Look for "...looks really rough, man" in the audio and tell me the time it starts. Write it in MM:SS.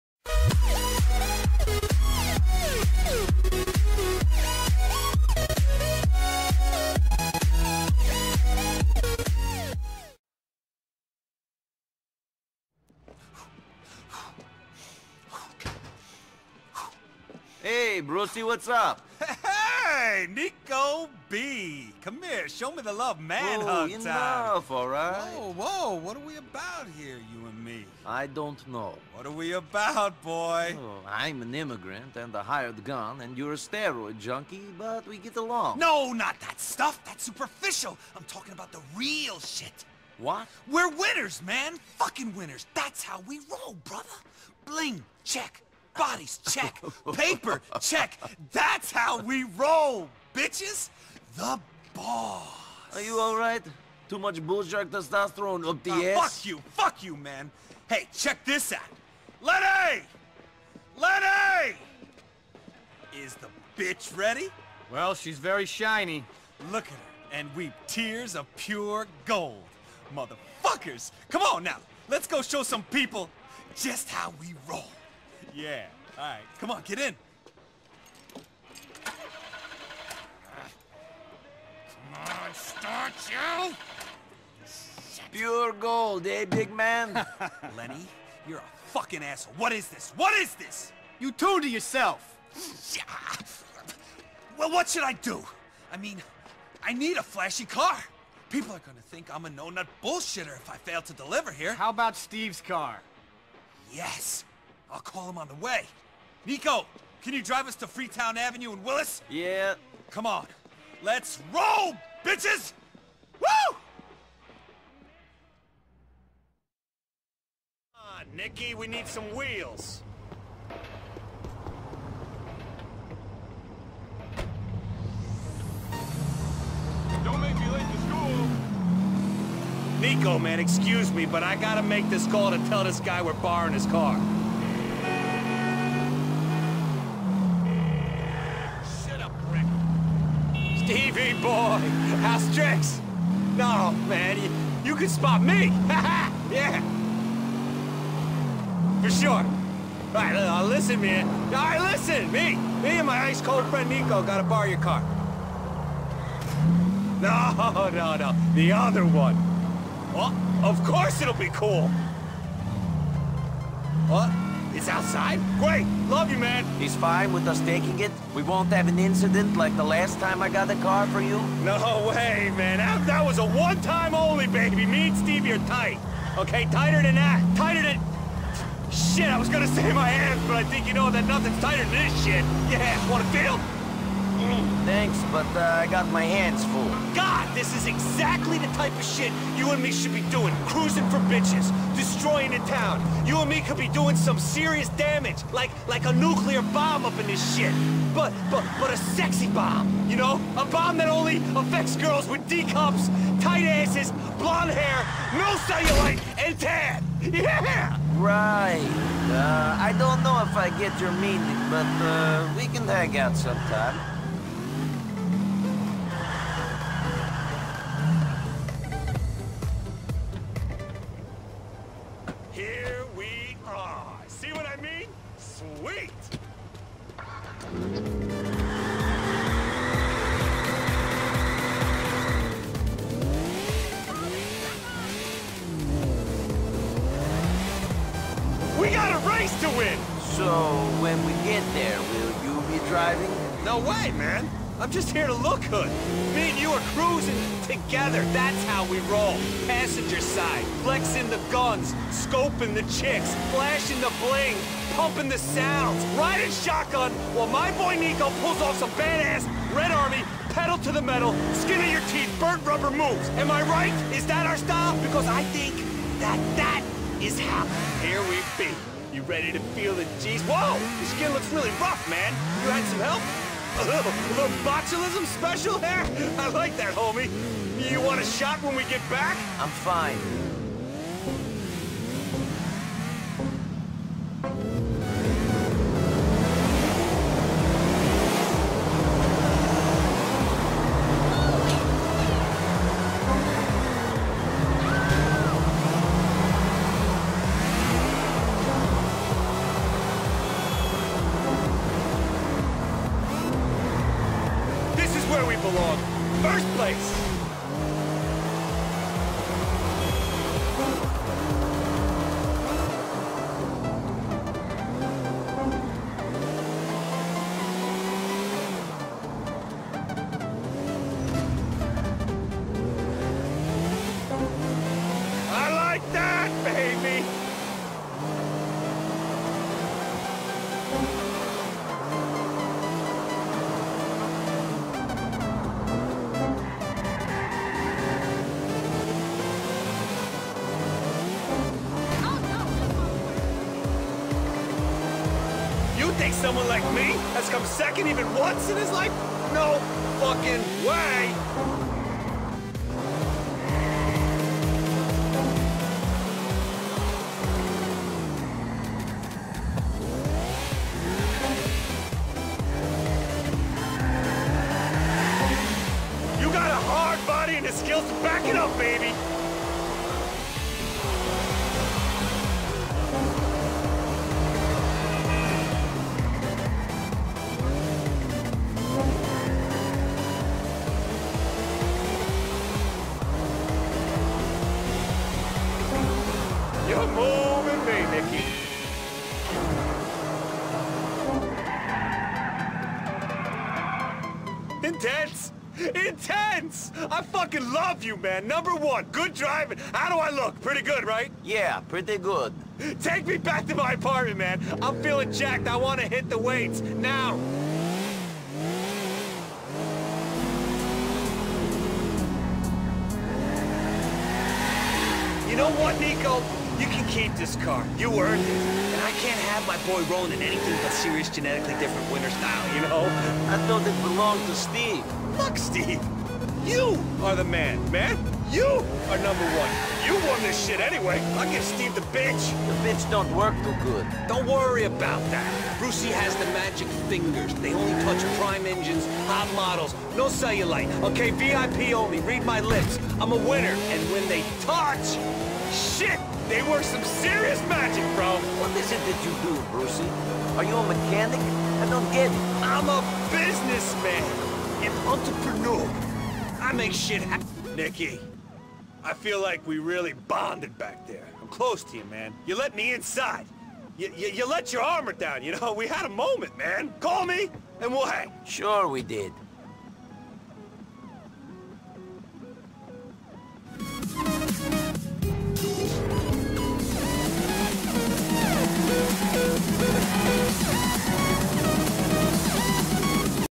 04:31.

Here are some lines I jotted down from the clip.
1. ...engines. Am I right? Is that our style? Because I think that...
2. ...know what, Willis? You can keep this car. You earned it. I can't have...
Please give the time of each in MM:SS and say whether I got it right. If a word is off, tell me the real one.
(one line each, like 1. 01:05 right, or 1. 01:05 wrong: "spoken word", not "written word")
1. 04:22 wrong: "moves", not "engines"
2. 06:55 wrong: "Niko", not "Willis".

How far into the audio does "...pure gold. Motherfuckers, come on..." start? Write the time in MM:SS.
01:08.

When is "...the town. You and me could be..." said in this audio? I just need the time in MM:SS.
03:12.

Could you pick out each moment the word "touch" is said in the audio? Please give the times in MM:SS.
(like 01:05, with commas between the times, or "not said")
07:18, 07:24.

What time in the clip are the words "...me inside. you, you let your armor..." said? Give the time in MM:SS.
07:42.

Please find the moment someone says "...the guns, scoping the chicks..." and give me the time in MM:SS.
04:11.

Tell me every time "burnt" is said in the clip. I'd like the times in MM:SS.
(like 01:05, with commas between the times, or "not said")
04:22.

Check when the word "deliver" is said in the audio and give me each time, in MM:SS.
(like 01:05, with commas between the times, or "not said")
01:41.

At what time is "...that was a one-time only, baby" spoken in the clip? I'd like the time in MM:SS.
02:53.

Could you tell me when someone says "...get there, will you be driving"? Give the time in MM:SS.
04:01.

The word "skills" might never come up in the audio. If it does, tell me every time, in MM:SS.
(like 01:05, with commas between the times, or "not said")
06:07.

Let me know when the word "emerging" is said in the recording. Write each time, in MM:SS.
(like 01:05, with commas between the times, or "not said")
not said.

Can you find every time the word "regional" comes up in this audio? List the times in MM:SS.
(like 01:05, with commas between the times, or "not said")
not said.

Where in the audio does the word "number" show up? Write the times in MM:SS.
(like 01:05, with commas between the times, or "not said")
06:38, 07:09.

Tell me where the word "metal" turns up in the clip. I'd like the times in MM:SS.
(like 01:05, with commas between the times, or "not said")
04:21.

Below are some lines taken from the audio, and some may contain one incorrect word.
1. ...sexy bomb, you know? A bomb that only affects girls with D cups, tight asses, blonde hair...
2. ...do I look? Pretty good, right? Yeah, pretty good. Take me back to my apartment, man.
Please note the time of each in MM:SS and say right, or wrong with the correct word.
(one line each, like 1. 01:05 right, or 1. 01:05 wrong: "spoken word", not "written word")
1. 03:18 right
2. 06:40 right.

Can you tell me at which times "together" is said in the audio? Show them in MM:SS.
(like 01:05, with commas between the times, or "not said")
04:07.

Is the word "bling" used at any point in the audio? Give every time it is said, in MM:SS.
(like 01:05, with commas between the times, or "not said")
00:44, 04:14.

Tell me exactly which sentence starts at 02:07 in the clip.
Don't make me late to school!